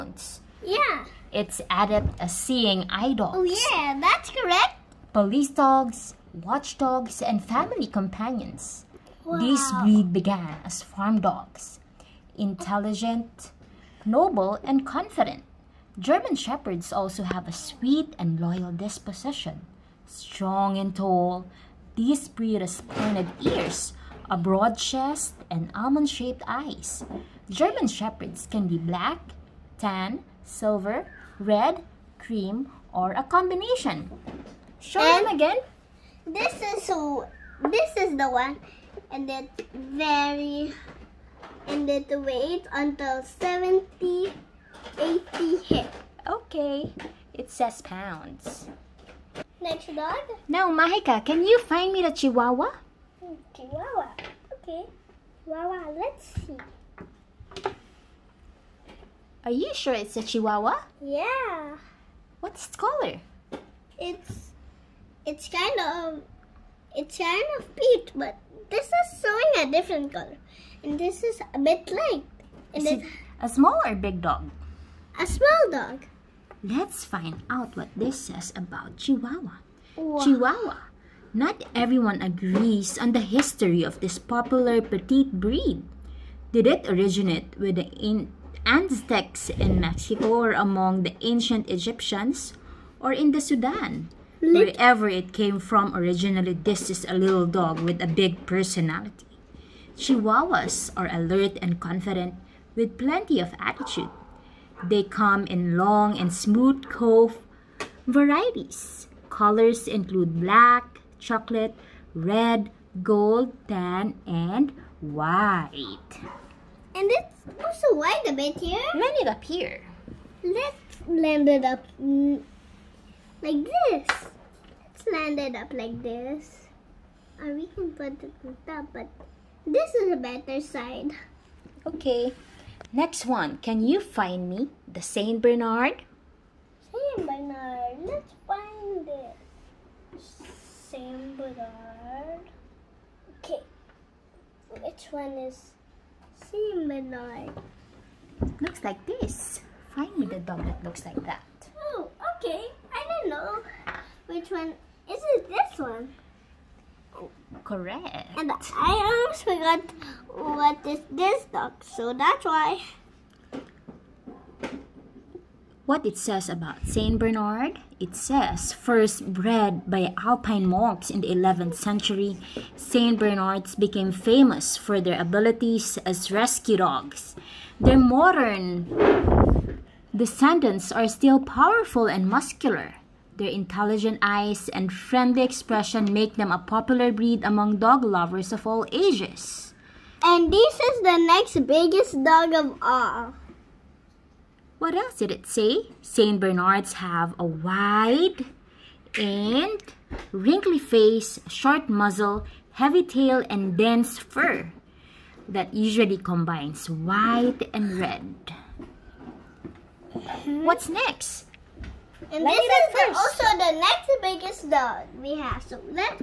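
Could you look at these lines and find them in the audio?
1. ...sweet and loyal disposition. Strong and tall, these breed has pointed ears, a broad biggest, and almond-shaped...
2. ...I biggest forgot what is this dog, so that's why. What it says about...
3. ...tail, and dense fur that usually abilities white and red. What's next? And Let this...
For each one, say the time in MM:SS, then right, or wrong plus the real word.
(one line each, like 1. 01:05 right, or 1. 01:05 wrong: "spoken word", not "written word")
1. 00:17 wrong: "chest", not "biggest"
2. 02:38 wrong: "almost", not "biggest"
3. 03:23 wrong: "combines", not "abilities".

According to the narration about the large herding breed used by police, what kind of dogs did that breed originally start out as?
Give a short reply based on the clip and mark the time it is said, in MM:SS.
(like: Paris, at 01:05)
farm dogs, at 00:10.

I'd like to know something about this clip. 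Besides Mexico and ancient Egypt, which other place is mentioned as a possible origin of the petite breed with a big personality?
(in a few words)
Sudan.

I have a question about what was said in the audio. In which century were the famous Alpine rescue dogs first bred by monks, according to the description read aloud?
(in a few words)
11th century.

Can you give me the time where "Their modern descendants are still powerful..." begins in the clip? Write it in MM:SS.
02:57.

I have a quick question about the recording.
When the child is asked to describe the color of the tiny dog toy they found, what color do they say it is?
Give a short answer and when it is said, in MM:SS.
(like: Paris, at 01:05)
peach, at 01:07.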